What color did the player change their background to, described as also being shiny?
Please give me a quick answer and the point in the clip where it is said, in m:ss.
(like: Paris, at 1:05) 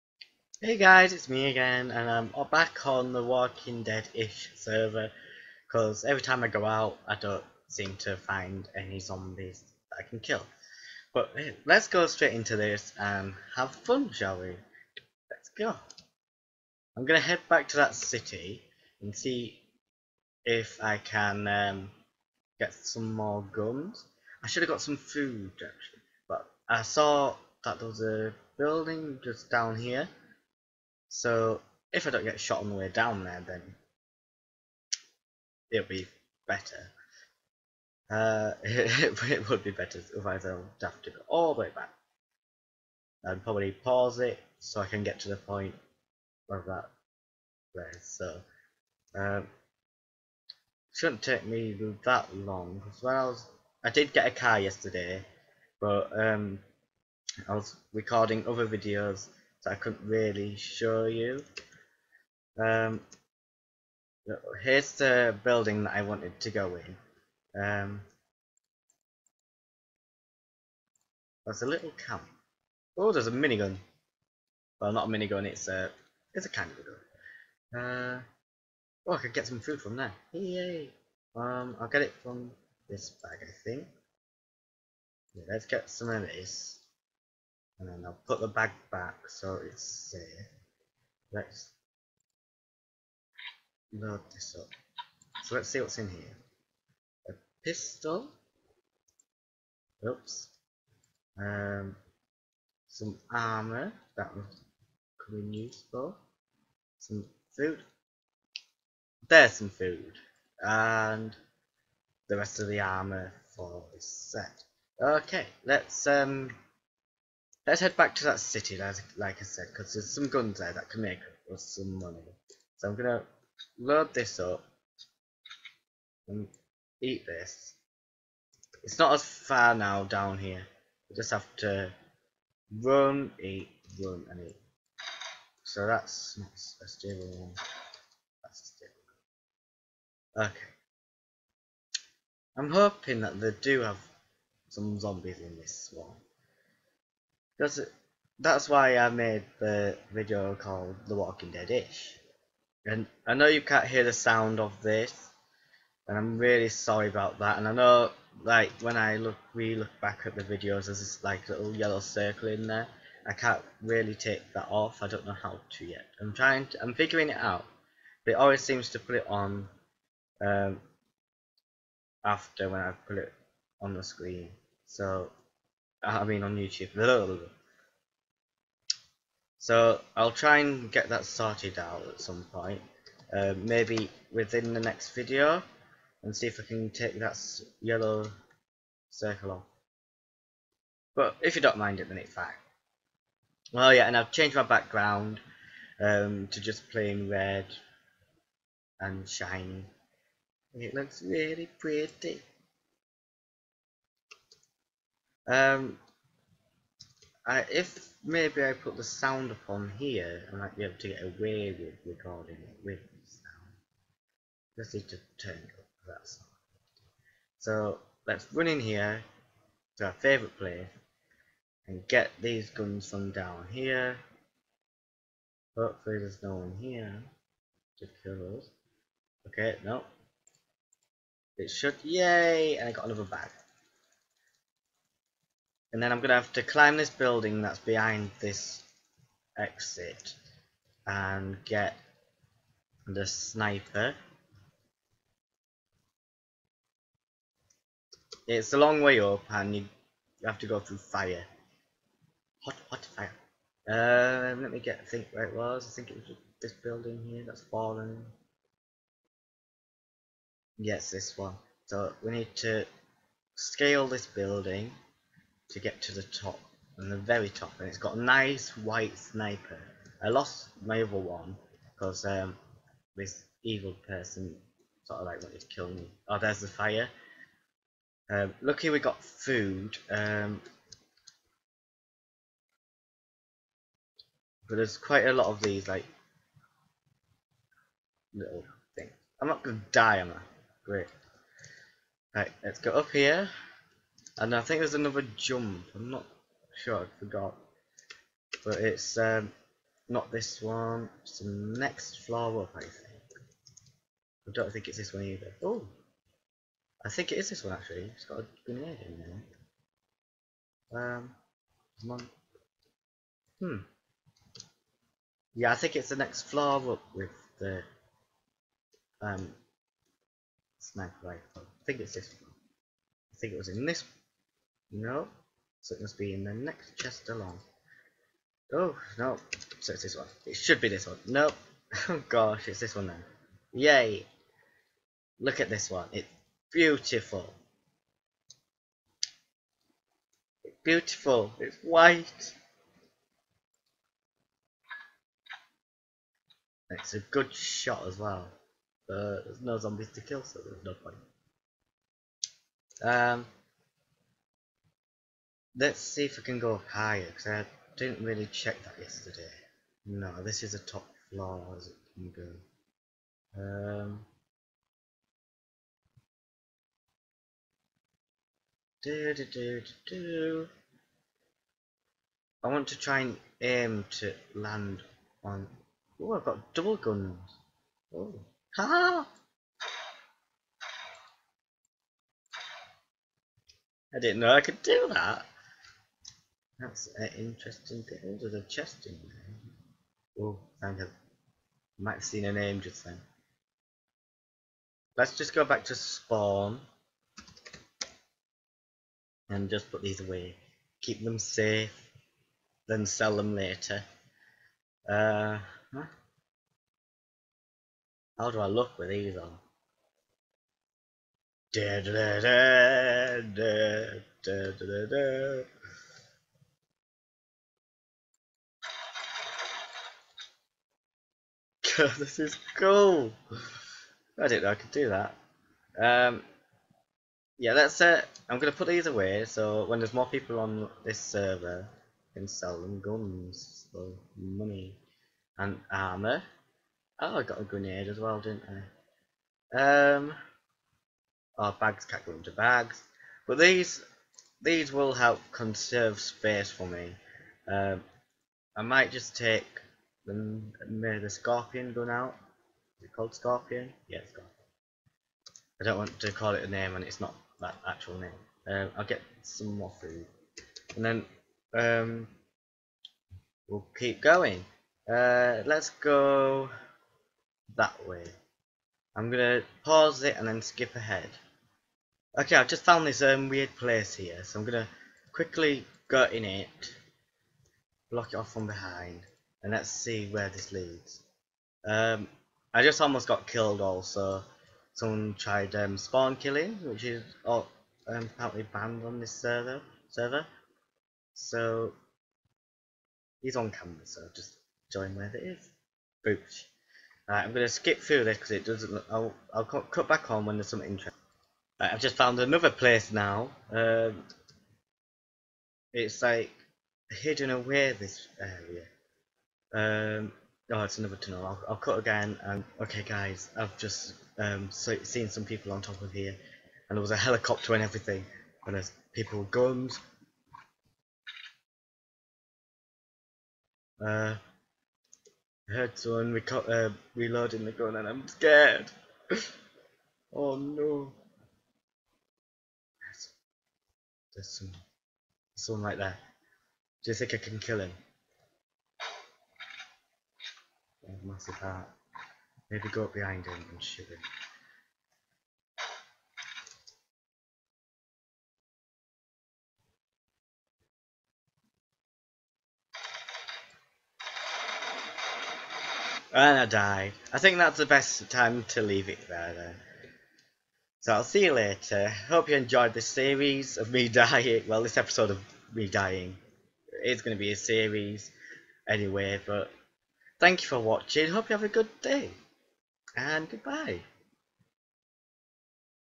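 red, at 3:16.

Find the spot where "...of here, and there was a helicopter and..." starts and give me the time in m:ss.
8:36.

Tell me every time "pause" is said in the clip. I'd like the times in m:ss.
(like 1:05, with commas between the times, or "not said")
0:43, 7:49.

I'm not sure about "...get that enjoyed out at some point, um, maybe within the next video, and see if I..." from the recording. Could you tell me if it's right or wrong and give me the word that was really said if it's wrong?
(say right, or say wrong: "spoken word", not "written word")
wrong: "sorted", not "enjoyed".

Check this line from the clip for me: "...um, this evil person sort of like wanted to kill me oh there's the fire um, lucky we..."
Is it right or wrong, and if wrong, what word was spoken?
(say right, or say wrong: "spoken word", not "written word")
right.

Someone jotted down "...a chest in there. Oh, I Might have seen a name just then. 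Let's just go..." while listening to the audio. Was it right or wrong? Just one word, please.
right.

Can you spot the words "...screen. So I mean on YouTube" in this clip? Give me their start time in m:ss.
2:54.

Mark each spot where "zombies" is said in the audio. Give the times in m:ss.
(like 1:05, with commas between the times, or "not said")
0:08, 2:24, 5:49.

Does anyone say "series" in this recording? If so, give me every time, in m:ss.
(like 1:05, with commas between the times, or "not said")
9:23, 9:27.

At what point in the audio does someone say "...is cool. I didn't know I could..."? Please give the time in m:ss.
7:02.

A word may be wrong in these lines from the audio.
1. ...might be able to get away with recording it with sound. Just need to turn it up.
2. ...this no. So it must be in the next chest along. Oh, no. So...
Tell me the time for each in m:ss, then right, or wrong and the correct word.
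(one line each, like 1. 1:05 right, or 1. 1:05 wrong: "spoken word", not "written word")
1. 3:30 right
2. 5:23 right.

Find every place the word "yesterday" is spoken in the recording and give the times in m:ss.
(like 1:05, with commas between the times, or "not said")
0:54, 5:59.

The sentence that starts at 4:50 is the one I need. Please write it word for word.
great right let's go up here and I think there's another jump.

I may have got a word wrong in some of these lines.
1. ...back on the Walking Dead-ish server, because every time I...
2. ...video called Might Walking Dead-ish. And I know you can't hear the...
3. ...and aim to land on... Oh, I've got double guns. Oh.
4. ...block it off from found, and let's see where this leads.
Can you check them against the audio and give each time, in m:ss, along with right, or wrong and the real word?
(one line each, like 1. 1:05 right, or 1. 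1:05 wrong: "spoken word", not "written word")
1. 0:02 right
2. 2:30 wrong: "The", not "Might"
3. 6:13 right
4. 7:58 wrong: "behind", not "found".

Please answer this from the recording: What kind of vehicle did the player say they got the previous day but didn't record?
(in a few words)
a car.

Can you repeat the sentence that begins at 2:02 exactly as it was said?
So I'm going to load this up and eat this.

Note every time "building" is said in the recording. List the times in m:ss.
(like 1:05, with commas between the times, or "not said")
0:28, 1:05, 3:57, 4:16, 4:24.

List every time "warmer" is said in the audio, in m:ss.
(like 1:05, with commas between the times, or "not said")
not said.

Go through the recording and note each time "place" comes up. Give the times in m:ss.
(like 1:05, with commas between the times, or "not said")
0:47, 3:40, 7:53, 8:22.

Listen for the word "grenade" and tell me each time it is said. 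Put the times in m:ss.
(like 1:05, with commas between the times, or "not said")
5:08, 7:17.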